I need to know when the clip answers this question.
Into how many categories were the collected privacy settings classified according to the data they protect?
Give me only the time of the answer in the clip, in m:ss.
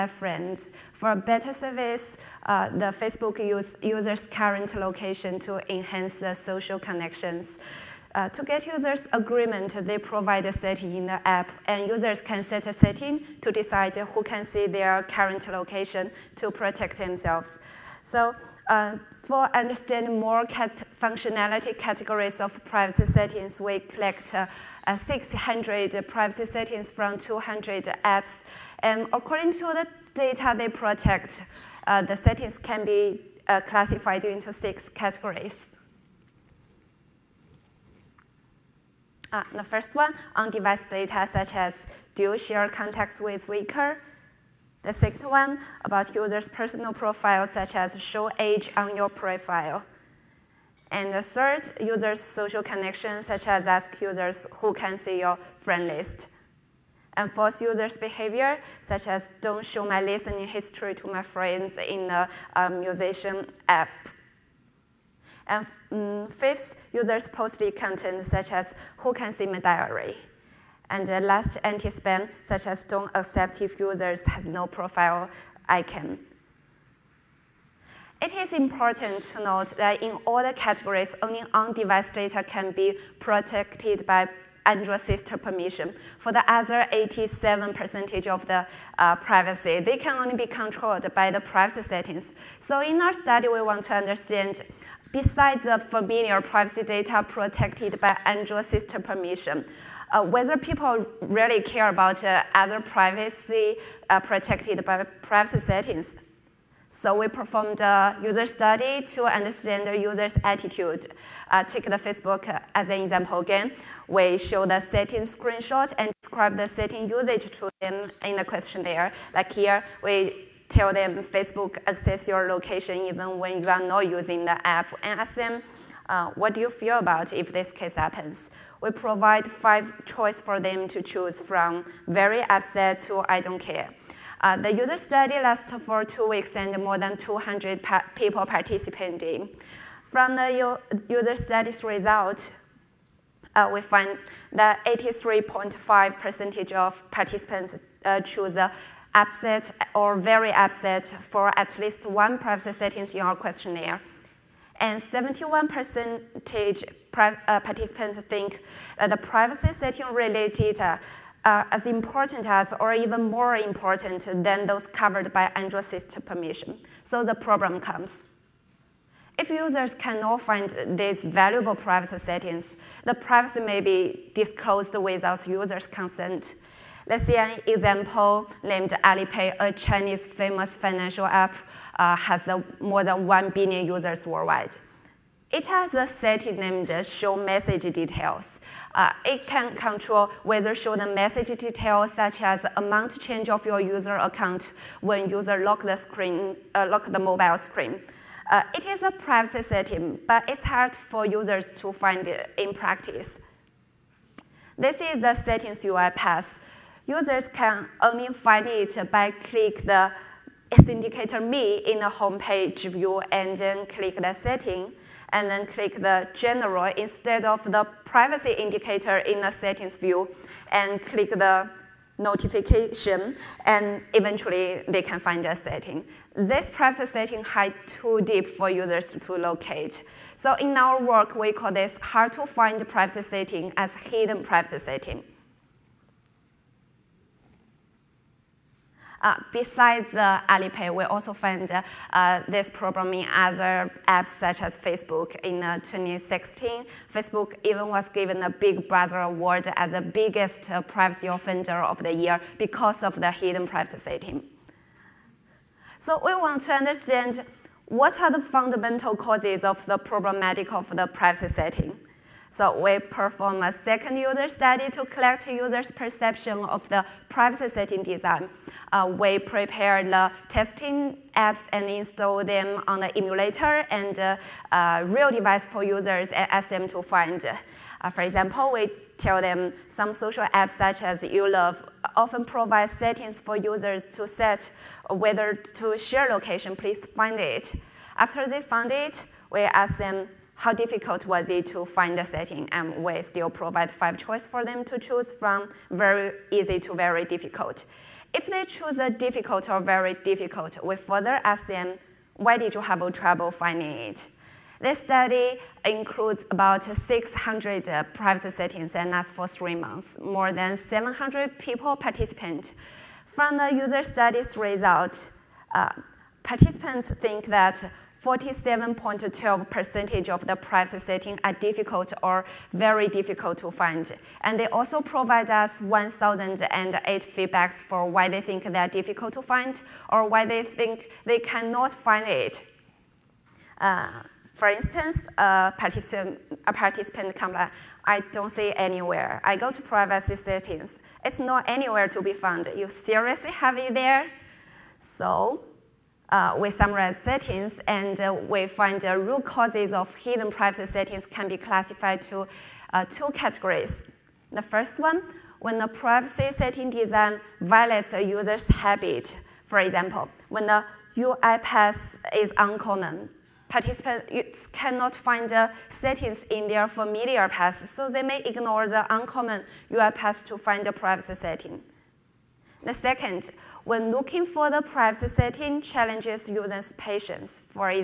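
0:34.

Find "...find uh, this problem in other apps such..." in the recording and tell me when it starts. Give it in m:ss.
4:01.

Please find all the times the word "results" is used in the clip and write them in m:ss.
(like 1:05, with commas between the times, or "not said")
2:21, 5:14.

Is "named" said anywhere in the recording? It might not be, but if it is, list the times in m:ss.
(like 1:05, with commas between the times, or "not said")
2:58, 3:06.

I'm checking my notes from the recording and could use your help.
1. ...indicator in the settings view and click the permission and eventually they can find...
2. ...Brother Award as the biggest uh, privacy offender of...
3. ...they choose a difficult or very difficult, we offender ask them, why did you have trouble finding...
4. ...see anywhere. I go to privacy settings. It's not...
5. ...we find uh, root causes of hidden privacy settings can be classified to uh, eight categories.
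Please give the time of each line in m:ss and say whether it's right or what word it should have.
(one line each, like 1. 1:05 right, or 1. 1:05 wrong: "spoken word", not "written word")
1. 3:38 wrong: "notification", not "permission"
2. 4:08 right
3. 4:58 wrong: "further", not "offender"
4. 5:38 right
5. 5:48 wrong: "two", not "eight".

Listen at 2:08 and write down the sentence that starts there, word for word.
we provide five choice for them to choose from very upset to I don't care.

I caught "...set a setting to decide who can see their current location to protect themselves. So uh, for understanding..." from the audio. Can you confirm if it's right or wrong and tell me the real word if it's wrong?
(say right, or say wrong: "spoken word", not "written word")
right.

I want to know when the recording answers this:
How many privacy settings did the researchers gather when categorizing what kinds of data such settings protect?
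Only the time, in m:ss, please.
0:24.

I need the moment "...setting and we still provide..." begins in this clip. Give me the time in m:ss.
4:52.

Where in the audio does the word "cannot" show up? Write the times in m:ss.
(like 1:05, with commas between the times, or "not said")
2:49, 5:31, 6:04.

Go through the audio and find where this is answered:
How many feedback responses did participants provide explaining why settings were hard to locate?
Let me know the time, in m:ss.
5:25.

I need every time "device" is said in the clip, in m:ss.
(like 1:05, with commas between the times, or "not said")
0:40, 1:21, 4:35.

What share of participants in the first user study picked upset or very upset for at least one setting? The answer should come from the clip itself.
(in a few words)
83.5%.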